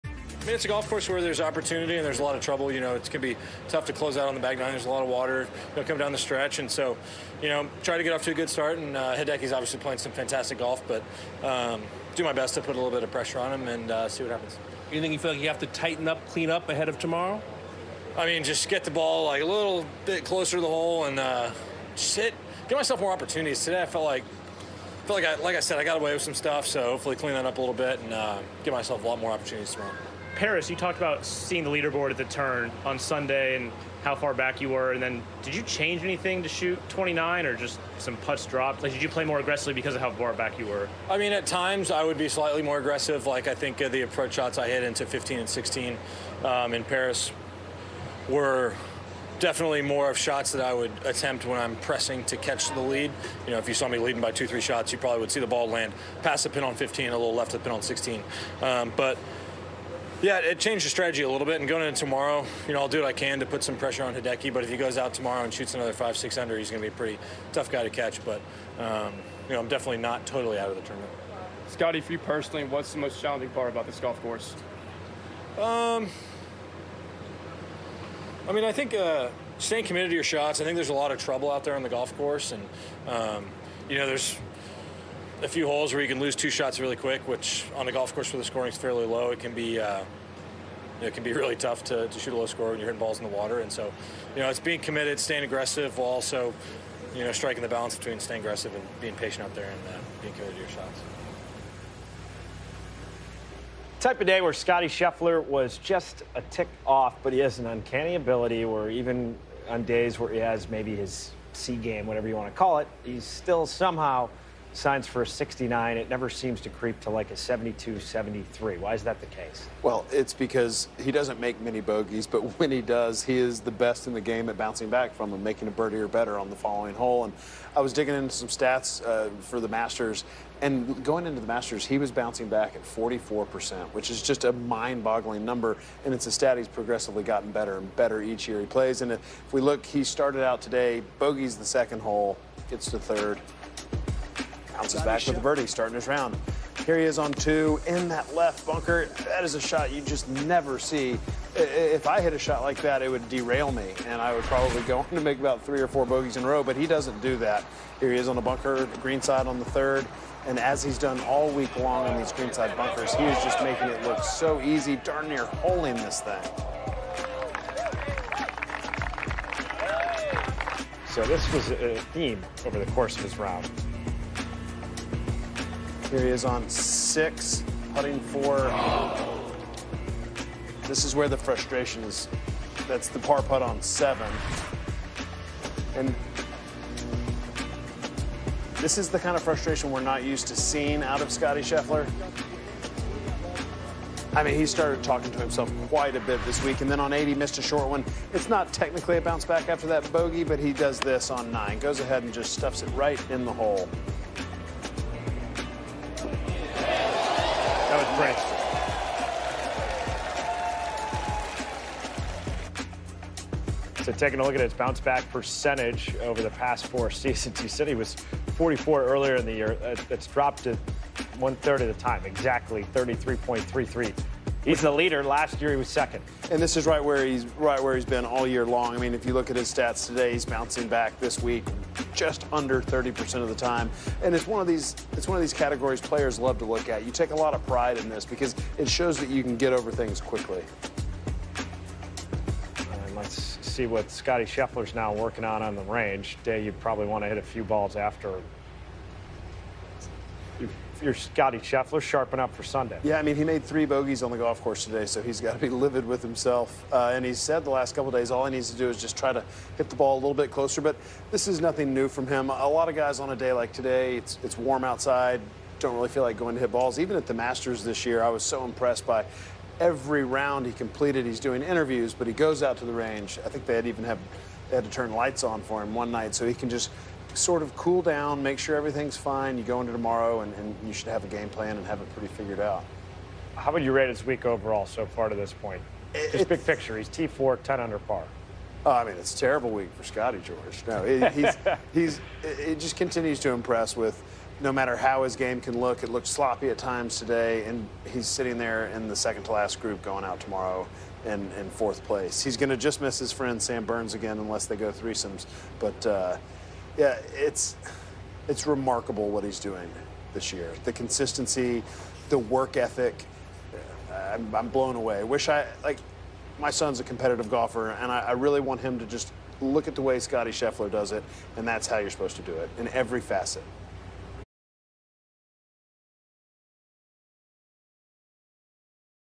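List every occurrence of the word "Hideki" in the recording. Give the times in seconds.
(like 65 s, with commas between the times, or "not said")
9 s, 64 s.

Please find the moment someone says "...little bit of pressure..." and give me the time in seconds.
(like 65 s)
12 s.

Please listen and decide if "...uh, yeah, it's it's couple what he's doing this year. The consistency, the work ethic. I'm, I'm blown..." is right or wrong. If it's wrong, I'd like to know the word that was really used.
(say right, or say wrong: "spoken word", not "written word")
wrong: "remarkable", not "couple".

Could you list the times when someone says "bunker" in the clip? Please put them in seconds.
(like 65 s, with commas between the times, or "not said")
148 s, 158 s, 162 s.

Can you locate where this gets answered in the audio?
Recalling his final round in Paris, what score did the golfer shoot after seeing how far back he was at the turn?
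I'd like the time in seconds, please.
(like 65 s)
36 s.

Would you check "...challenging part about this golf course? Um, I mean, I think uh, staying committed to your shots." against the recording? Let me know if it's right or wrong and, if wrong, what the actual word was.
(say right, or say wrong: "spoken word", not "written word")
right.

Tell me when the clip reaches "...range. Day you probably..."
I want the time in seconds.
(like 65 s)
245 s.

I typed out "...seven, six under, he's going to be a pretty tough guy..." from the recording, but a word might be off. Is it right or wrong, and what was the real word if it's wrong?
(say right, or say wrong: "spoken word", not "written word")
wrong: "five", not "seven".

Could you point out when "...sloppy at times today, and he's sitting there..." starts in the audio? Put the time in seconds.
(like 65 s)
296 s.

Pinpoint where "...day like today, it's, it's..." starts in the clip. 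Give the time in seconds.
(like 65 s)
263 s.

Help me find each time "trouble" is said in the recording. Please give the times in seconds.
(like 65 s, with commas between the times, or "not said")
2 s, 81 s.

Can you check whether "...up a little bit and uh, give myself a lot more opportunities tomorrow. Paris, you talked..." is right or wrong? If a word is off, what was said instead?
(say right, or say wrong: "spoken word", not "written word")
right.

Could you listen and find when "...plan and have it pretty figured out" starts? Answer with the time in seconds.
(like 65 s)
281 s.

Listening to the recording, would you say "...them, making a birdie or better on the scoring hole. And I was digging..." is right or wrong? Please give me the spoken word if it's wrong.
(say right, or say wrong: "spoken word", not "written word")
wrong: "following", not "scoring".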